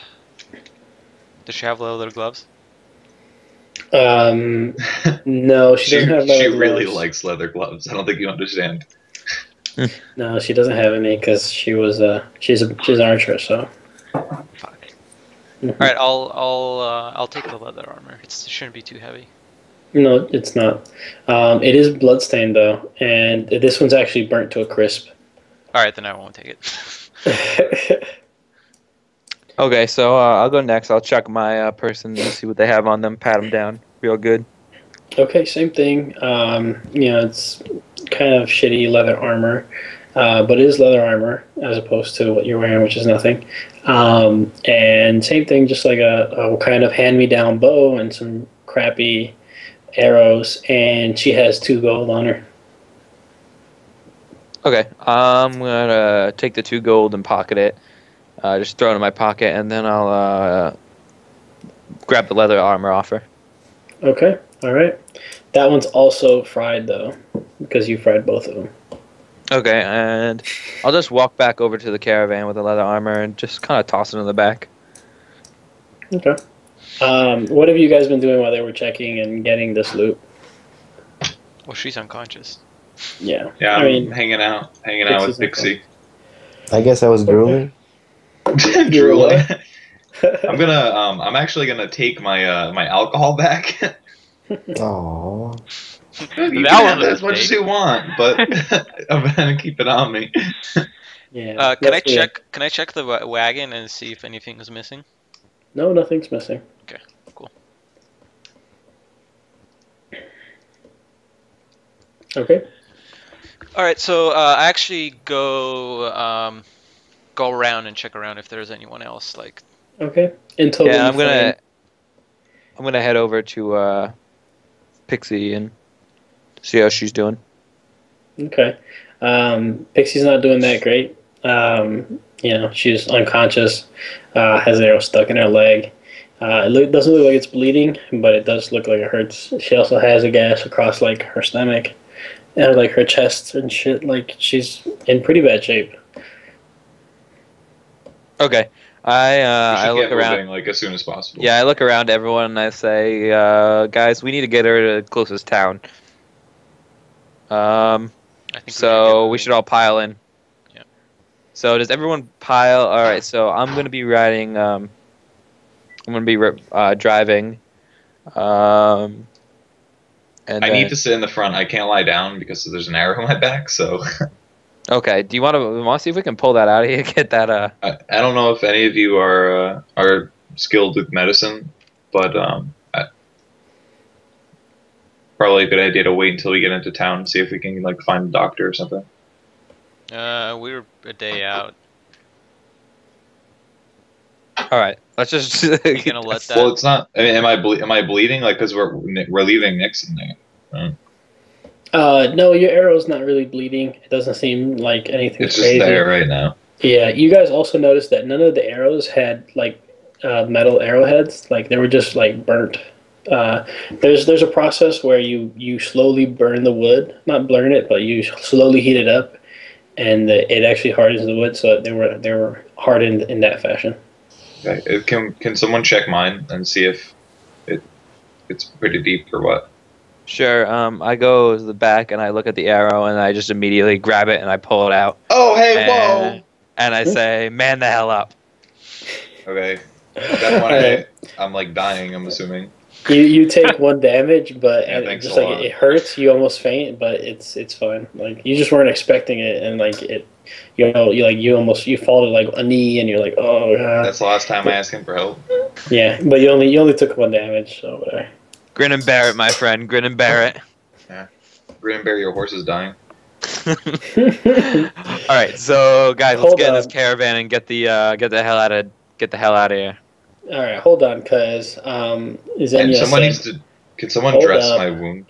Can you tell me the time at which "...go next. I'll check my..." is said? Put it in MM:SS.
00:30.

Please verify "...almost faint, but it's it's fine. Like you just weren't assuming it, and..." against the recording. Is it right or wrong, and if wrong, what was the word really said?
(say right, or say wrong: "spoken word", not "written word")
wrong: "expecting", not "assuming".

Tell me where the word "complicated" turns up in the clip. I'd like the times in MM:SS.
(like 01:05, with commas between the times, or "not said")
not said.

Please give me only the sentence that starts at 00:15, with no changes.
All right, I'll I'll uh, I'll take the leather armor.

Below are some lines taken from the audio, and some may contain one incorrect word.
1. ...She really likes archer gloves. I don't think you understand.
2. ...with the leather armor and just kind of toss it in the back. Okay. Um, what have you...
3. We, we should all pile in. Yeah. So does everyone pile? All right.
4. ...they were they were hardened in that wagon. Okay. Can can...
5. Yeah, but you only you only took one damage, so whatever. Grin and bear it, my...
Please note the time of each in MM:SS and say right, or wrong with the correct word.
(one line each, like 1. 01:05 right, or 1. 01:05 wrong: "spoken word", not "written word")
1. 00:06 wrong: "leather", not "archer"
2. 01:12 right
3. 02:39 right
4. 03:41 wrong: "fashion", not "wagon"
5. 04:15 right.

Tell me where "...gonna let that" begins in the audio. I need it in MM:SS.
03:16.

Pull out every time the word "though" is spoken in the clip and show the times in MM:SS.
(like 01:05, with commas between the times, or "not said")
00:22, 01:06.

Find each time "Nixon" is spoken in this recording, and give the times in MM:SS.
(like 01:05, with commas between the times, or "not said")
03:19.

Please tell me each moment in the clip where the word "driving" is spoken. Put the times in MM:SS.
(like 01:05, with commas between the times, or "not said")
02:46.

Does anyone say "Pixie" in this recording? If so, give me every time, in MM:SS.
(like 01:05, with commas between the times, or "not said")
01:25, 02:05, 02:09.